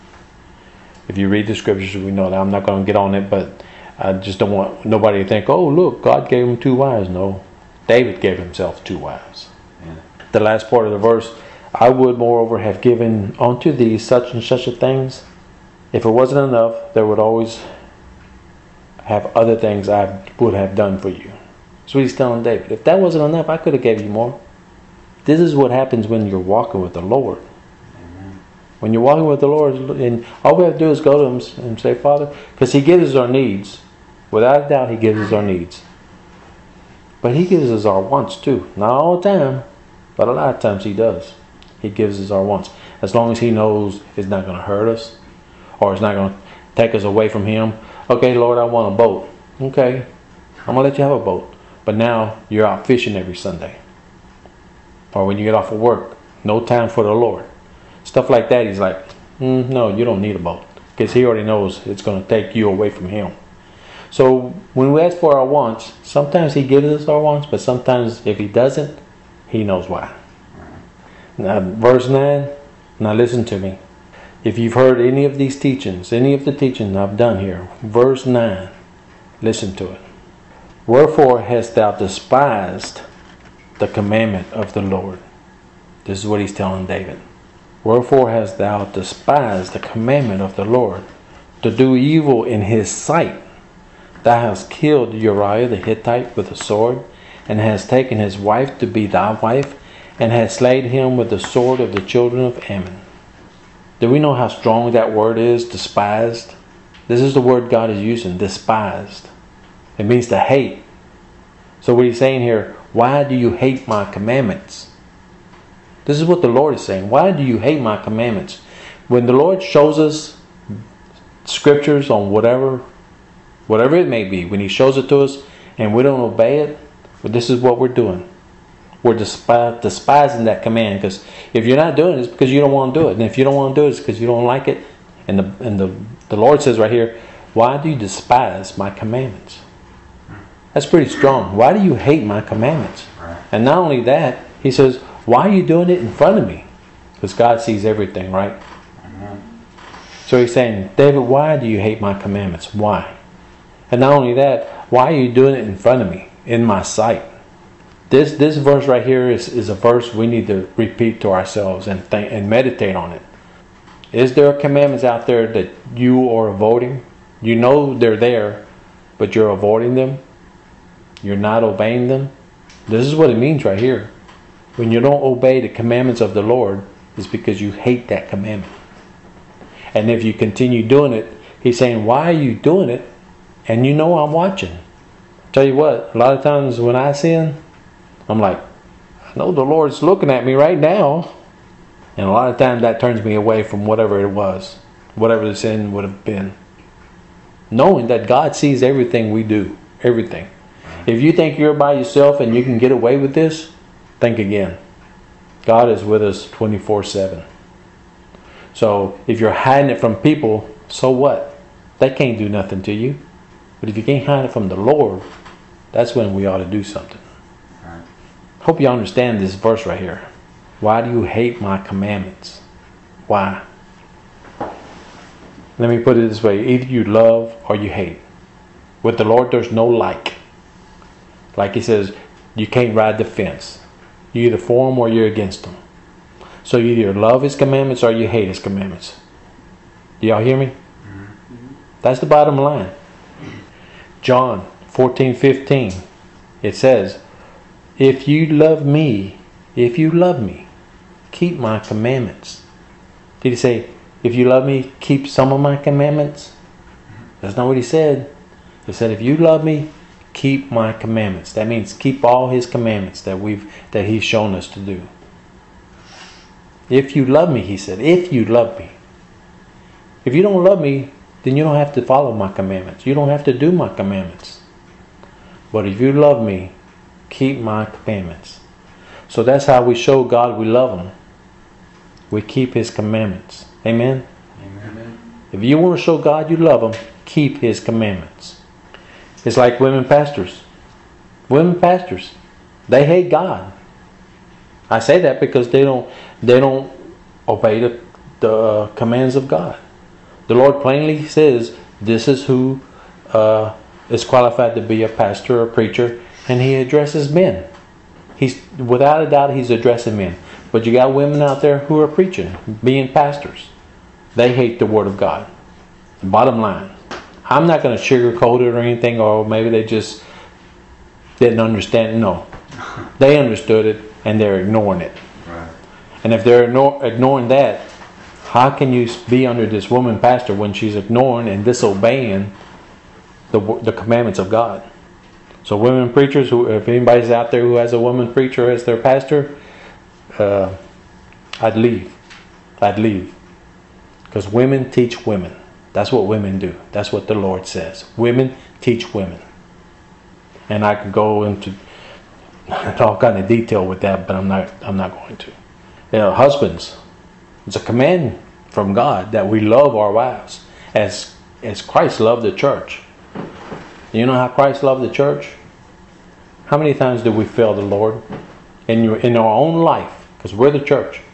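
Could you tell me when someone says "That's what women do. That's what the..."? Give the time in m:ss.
5:45.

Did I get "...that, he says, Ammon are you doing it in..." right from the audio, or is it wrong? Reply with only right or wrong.
wrong.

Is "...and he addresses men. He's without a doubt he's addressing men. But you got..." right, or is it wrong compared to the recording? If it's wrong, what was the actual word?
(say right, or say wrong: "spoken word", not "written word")
right.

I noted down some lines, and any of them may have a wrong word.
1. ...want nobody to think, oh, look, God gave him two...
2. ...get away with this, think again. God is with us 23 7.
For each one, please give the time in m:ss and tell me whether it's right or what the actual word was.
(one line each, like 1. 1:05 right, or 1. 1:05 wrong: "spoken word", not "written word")
1. 0:04 right
2. 3:22 wrong: "24", not "23".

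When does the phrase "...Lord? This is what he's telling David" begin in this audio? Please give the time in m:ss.
1:24.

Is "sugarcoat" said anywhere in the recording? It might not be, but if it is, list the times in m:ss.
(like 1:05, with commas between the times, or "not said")
5:18.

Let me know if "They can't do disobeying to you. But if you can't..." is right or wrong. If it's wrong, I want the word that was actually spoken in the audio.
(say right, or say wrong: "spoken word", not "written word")
wrong: "nothing", not "disobeying".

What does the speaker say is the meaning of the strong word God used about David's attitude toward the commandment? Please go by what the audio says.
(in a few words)
To hate.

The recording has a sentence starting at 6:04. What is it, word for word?
You know how Christ loved the church?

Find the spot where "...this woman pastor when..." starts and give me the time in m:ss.
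5:29.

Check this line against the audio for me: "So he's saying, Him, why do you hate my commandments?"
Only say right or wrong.
wrong.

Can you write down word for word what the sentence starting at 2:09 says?
We're despi- despising that command because if you're not doing it, it's because you don't want to do it.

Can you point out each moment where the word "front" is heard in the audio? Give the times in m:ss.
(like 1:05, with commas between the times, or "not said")
2:26, 2:35.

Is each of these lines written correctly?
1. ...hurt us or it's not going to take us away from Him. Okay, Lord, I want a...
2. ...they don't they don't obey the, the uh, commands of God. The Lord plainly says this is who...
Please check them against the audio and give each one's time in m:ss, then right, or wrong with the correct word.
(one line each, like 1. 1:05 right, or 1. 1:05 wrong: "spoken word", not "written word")
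1. 0:44 right
2. 4:55 right.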